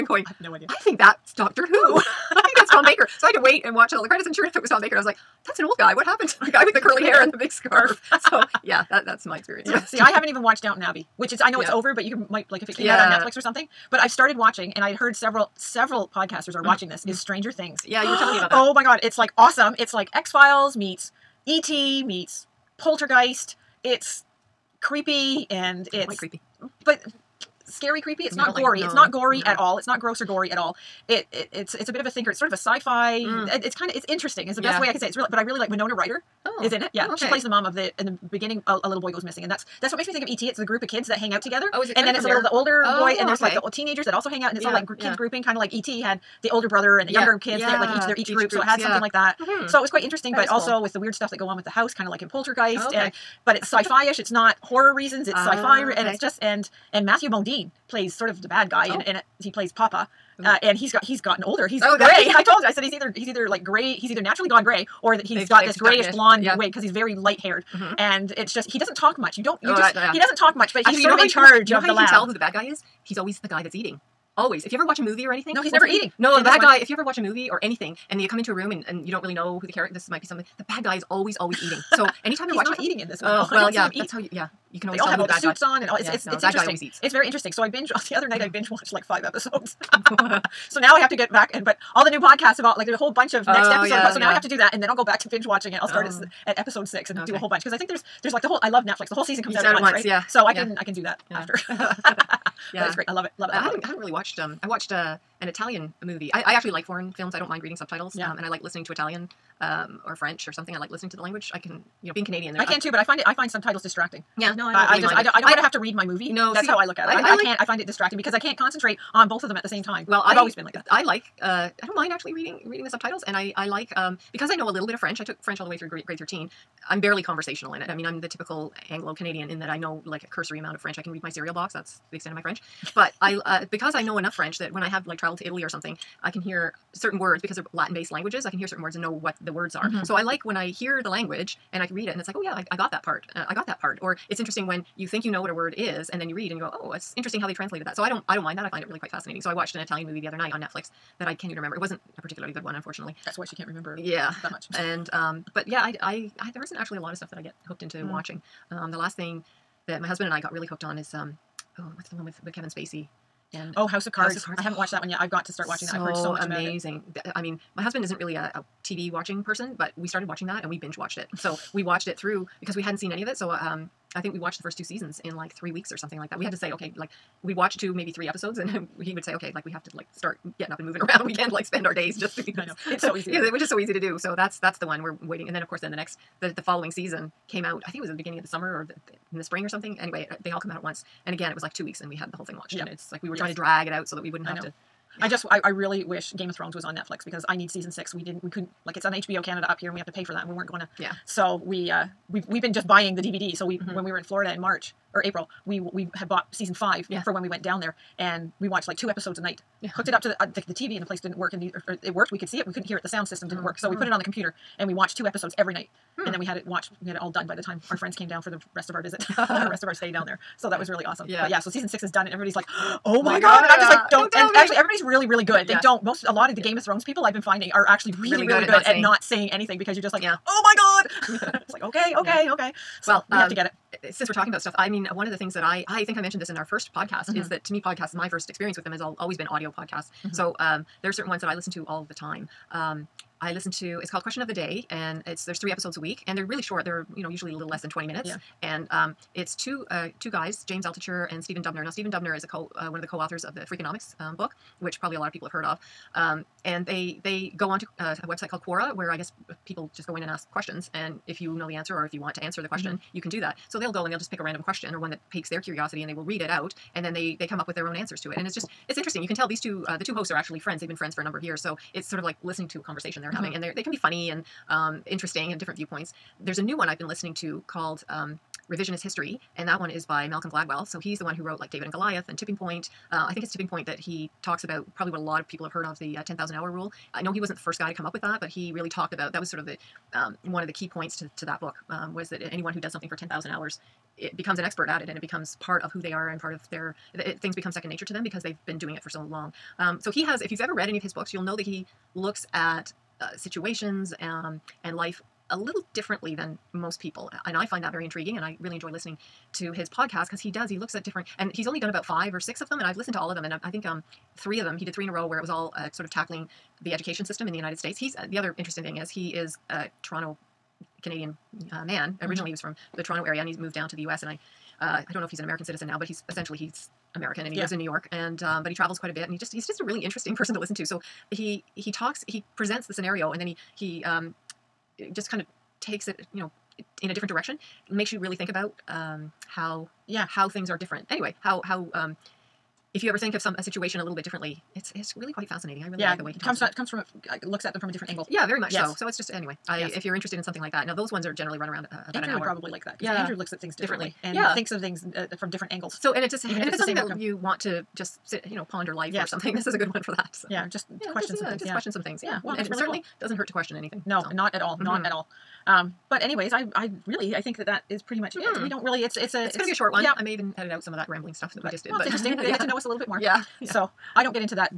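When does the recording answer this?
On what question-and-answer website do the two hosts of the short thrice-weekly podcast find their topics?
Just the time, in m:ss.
4:18.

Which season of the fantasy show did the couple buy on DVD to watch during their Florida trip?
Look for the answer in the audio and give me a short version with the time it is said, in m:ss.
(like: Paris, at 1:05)
season 5, at 3:26.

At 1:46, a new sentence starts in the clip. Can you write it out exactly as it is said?
I, I actually like foreign films.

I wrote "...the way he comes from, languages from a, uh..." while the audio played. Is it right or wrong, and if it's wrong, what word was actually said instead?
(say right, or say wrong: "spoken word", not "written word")
wrong: "comes", not "languages".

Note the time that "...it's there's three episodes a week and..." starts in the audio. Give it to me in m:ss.
4:05.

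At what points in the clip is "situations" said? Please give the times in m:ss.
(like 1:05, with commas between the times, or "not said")
5:03, 5:43.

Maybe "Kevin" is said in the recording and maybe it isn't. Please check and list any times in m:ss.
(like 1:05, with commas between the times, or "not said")
2:42.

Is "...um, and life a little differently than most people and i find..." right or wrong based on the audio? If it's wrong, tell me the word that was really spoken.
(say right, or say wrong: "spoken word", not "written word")
right.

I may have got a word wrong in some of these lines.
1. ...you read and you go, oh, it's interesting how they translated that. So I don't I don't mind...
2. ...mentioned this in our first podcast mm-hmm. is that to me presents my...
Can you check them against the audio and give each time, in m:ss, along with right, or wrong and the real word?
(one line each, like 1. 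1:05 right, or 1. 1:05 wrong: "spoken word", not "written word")
1. 2:26 right
2. 3:56 wrong: "podcasts", not "presents".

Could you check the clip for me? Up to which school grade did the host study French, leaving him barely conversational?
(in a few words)
grade 13.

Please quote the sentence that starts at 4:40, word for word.
So he's the one who wrote like David and Goliath and Tipping Point.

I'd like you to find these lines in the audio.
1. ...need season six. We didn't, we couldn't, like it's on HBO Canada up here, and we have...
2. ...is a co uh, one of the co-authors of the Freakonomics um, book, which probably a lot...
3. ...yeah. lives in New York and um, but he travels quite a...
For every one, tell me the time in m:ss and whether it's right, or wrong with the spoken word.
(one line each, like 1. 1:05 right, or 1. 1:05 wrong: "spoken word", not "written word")
1. 3:17 right
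2. 4:12 right
3. 5:27 right.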